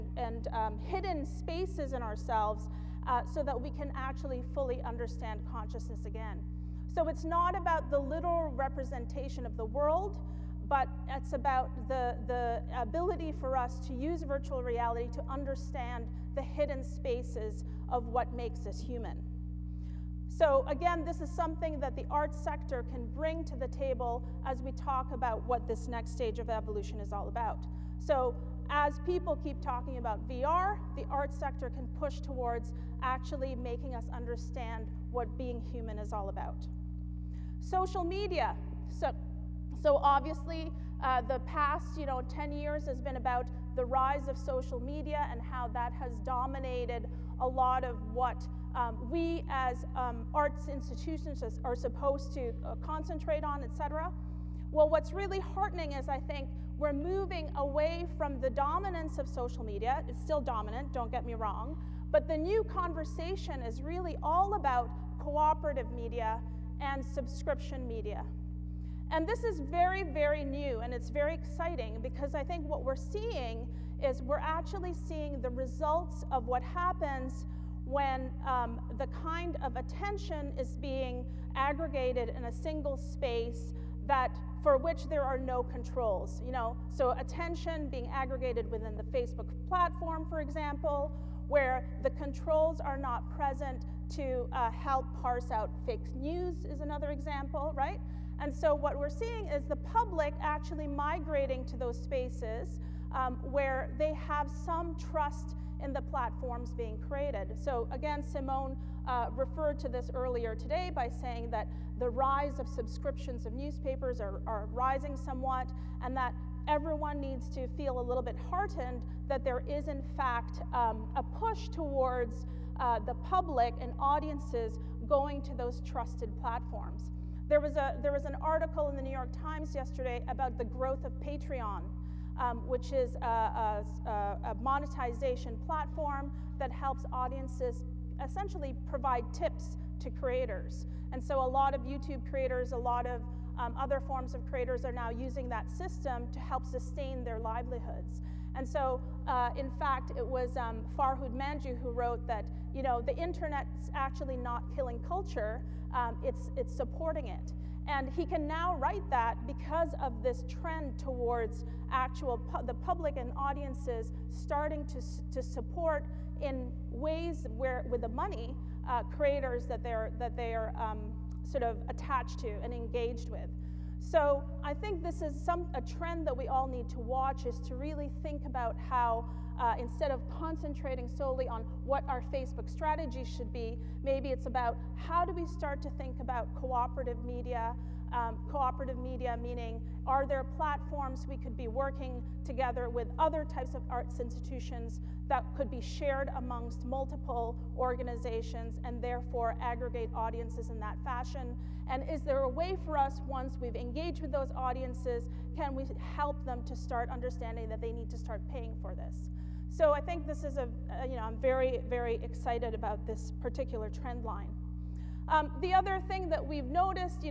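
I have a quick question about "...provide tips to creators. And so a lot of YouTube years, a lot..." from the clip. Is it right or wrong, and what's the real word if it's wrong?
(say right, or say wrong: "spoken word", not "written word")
wrong: "creators", not "years".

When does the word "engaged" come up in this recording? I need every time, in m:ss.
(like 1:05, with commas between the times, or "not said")
2:52, 3:23.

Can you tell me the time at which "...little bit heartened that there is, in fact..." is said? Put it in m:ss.
1:58.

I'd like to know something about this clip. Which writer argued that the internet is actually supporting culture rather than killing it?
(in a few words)
Farhad Manjoo.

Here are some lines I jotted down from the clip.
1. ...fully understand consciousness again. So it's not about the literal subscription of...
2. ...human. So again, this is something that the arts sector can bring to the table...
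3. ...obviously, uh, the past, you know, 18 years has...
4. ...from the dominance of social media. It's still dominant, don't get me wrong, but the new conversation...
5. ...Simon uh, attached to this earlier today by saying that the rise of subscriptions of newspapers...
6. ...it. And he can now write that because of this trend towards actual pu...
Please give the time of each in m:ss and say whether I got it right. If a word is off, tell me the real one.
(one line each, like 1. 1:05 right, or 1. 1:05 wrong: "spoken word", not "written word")
1. 0:04 wrong: "representation", not "subscription"
2. 0:18 right
3. 0:40 wrong: "10", not "18"
4. 0:58 right
5. 1:48 wrong: "referred", not "attached"
6. 2:37 right.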